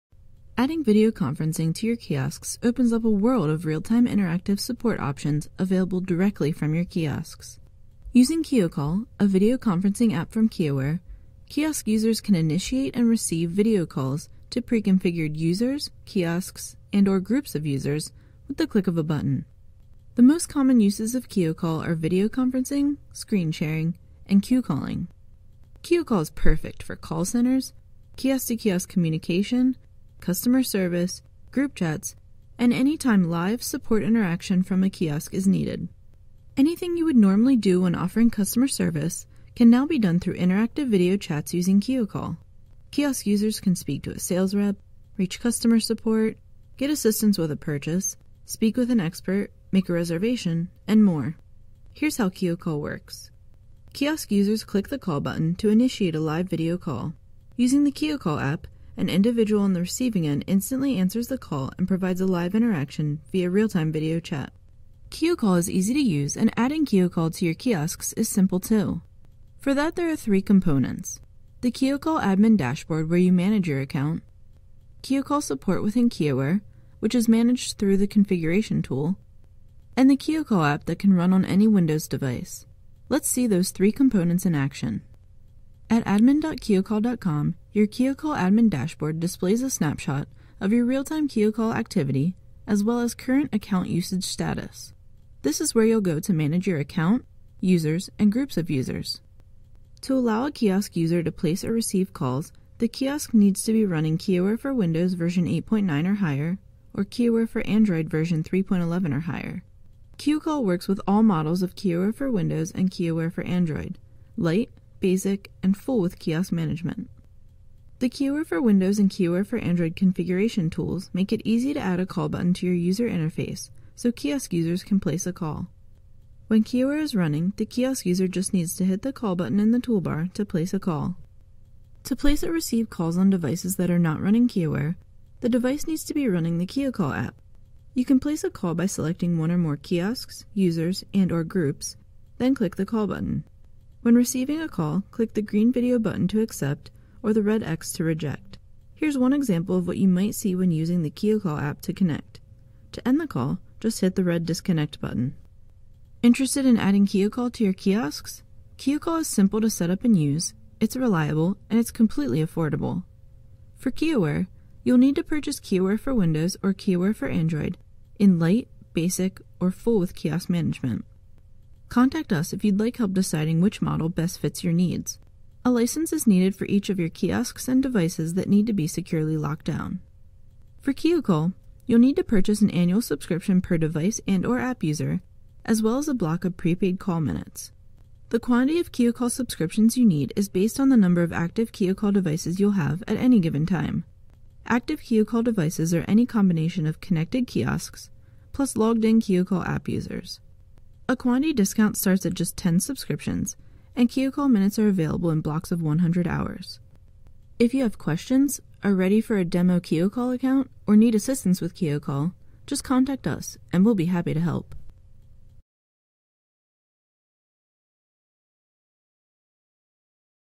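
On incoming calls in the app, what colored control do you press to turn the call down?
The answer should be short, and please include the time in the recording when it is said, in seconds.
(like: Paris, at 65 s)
red X, at 147 s.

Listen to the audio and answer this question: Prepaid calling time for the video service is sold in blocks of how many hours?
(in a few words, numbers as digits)
100 hours.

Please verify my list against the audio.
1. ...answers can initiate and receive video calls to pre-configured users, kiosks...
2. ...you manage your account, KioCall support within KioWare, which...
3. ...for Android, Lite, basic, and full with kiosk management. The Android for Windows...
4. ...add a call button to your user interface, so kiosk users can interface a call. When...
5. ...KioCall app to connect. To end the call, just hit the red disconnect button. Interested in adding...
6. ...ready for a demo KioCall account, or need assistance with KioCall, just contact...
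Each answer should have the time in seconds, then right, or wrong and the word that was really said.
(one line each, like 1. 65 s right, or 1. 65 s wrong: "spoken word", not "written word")
1. 11 s wrong: "users", not "answers"
2. 73 s right
3. 113 s wrong: "KioWare", not "Android"
4. 121 s wrong: "place", not "interface"
5. 151 s right
6. 208 s right.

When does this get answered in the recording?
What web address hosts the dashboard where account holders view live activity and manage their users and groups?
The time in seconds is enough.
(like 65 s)
86 s.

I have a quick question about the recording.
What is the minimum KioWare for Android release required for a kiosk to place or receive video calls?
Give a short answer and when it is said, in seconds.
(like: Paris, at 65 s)
3.11, at 108 s.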